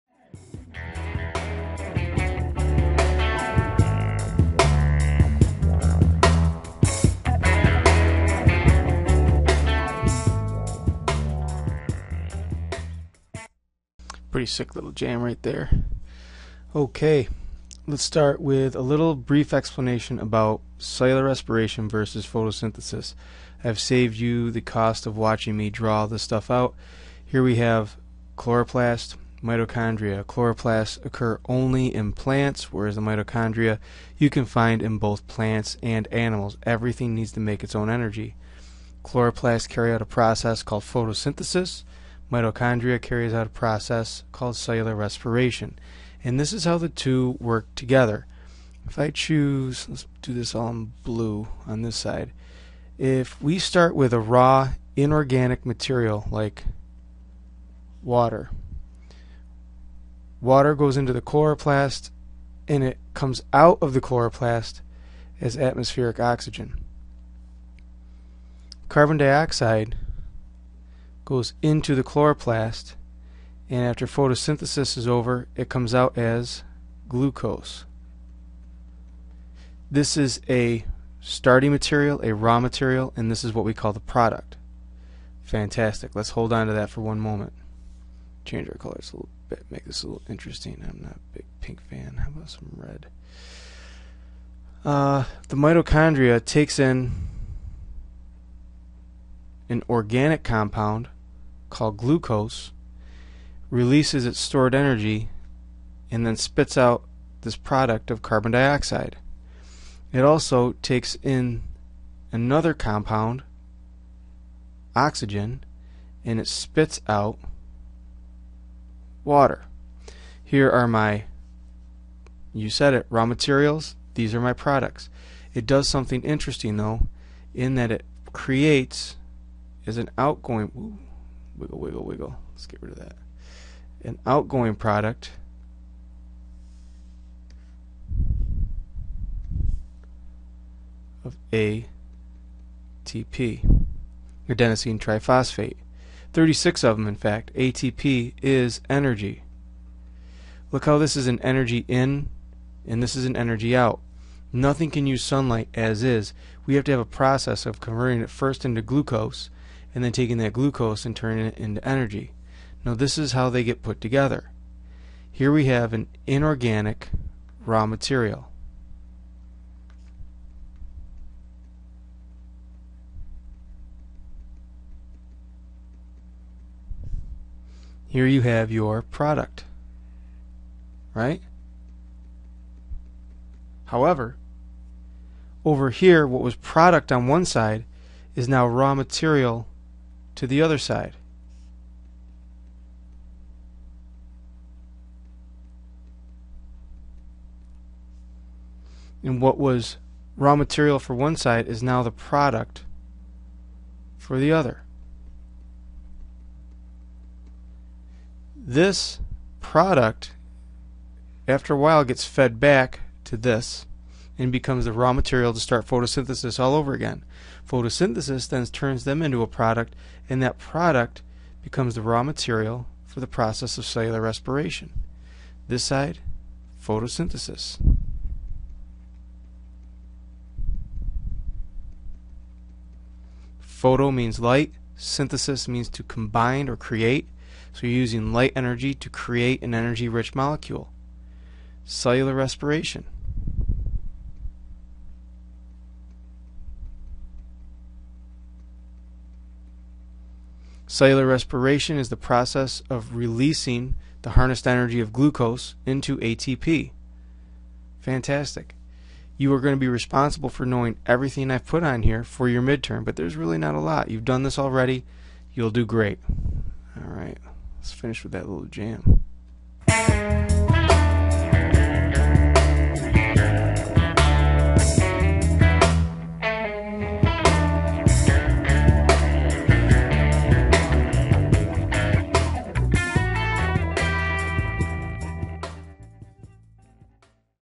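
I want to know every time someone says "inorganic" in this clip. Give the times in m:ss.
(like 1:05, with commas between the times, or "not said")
0:54, 2:46.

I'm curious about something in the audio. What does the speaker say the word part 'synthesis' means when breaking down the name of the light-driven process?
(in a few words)
To combine or create.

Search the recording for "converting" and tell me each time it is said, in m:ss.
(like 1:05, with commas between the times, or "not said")
2:37.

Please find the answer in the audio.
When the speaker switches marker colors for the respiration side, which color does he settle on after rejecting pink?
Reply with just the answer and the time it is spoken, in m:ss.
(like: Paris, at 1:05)
Red, at 1:32.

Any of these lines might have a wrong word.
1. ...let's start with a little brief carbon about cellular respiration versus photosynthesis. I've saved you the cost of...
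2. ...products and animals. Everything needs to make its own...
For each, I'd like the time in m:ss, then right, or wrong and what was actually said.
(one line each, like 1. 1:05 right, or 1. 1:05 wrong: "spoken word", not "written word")
1. 0:17 wrong: "explanation", not "carbon"
2. 0:35 wrong: "plants", not "products".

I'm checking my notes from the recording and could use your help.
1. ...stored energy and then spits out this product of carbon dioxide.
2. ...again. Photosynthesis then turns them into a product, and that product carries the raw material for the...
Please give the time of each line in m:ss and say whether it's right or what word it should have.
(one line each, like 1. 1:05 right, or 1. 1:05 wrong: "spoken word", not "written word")
1. 1:44 right
2. 3:36 wrong: "becomes", not "carries".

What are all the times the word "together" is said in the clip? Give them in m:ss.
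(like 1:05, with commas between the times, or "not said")
0:47, 2:44.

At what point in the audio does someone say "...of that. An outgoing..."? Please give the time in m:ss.
2:12.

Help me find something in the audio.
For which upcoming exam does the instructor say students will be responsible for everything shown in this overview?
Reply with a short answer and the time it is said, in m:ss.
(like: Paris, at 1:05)
Midterm, at 4:22.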